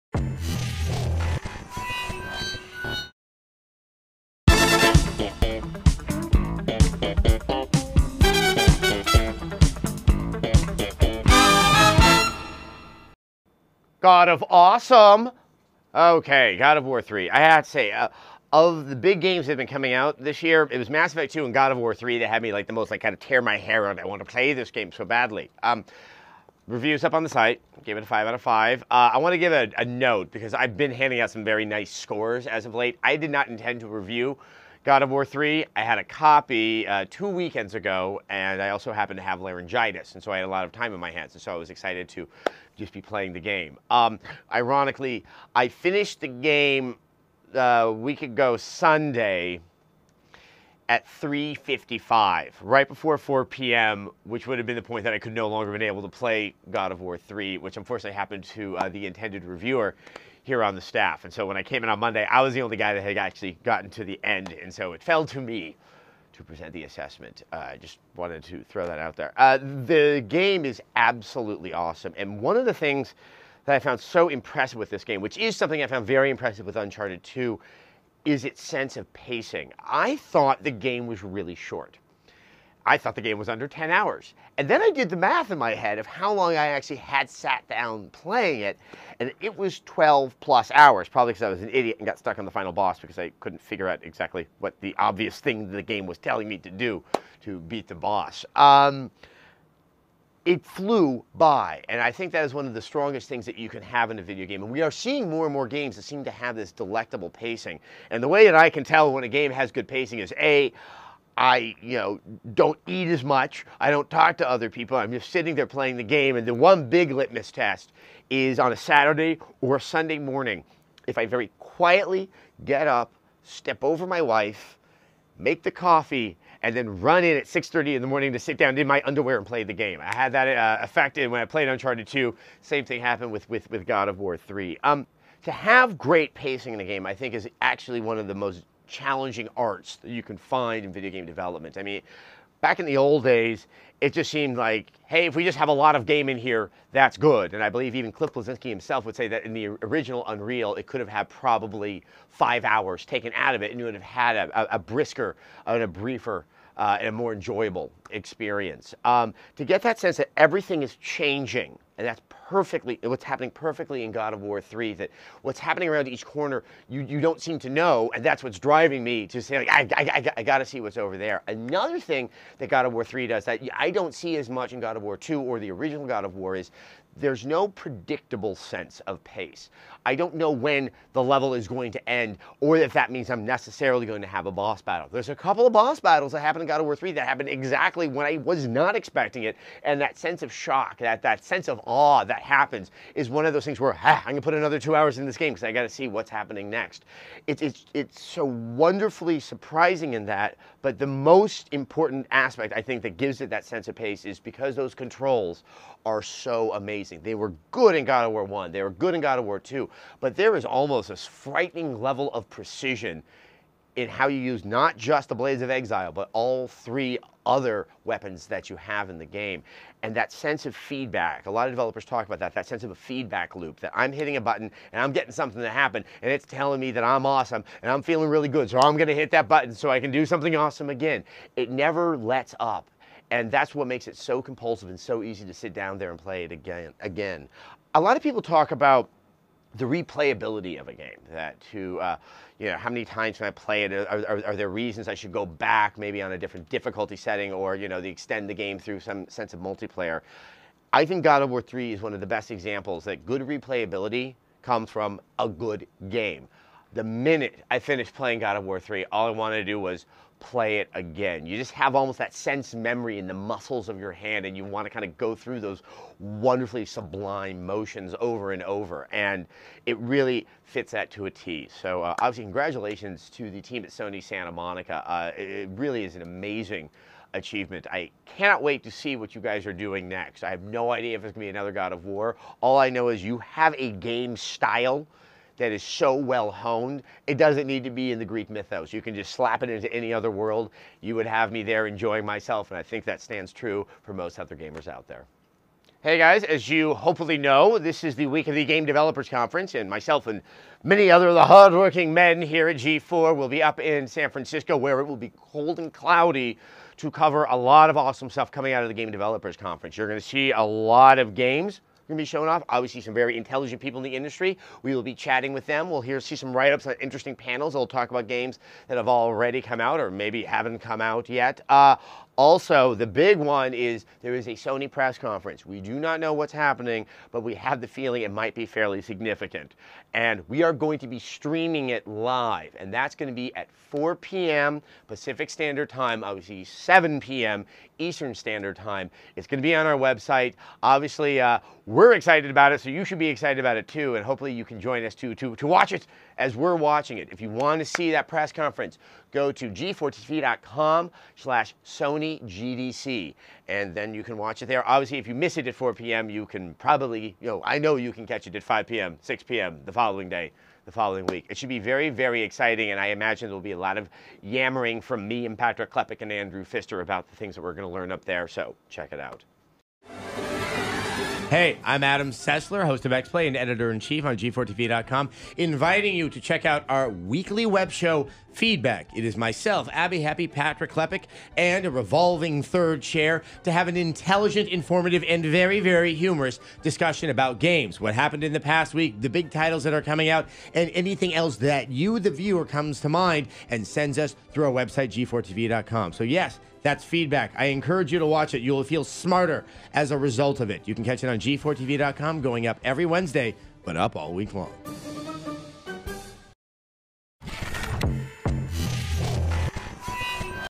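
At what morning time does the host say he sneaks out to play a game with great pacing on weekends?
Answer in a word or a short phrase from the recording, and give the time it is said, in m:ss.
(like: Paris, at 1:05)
6:30, at 2:07.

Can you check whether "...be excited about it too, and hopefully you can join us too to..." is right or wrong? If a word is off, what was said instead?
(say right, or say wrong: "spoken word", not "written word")
right.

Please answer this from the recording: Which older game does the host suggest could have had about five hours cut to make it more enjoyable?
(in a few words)
Unreal.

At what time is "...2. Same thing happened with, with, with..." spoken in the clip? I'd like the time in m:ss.
2:12.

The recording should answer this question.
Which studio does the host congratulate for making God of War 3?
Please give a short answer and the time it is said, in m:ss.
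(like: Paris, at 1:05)
Sony Santa Monica, at 4:33.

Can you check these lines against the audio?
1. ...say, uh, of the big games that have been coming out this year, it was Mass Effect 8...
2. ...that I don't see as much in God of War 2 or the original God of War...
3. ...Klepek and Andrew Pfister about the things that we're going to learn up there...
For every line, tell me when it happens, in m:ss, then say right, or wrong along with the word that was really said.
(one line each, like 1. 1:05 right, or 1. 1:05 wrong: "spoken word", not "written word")
1. 0:17 wrong: "2", not "8"
2. 2:53 right
3. 6:05 right.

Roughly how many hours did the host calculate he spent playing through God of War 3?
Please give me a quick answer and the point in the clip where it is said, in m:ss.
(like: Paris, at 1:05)
12+ hours, at 1:29.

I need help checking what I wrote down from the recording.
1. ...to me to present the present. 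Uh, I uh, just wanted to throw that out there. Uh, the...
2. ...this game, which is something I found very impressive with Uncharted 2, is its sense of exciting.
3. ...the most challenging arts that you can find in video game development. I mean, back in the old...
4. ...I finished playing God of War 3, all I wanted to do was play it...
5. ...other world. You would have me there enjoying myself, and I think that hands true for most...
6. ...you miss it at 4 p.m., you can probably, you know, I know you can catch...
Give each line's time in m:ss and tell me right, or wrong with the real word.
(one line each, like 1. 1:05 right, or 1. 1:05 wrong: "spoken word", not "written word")
1. 1:05 wrong: "assessment", not "present"
2. 1:14 wrong: "pacing", not "exciting"
3. 2:18 right
4. 4:17 right
5. 4:50 wrong: "stands", not "hands"
6. 5:55 right.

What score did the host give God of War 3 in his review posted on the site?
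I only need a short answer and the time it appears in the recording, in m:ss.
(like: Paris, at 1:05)
5 out of 5, at 0:28.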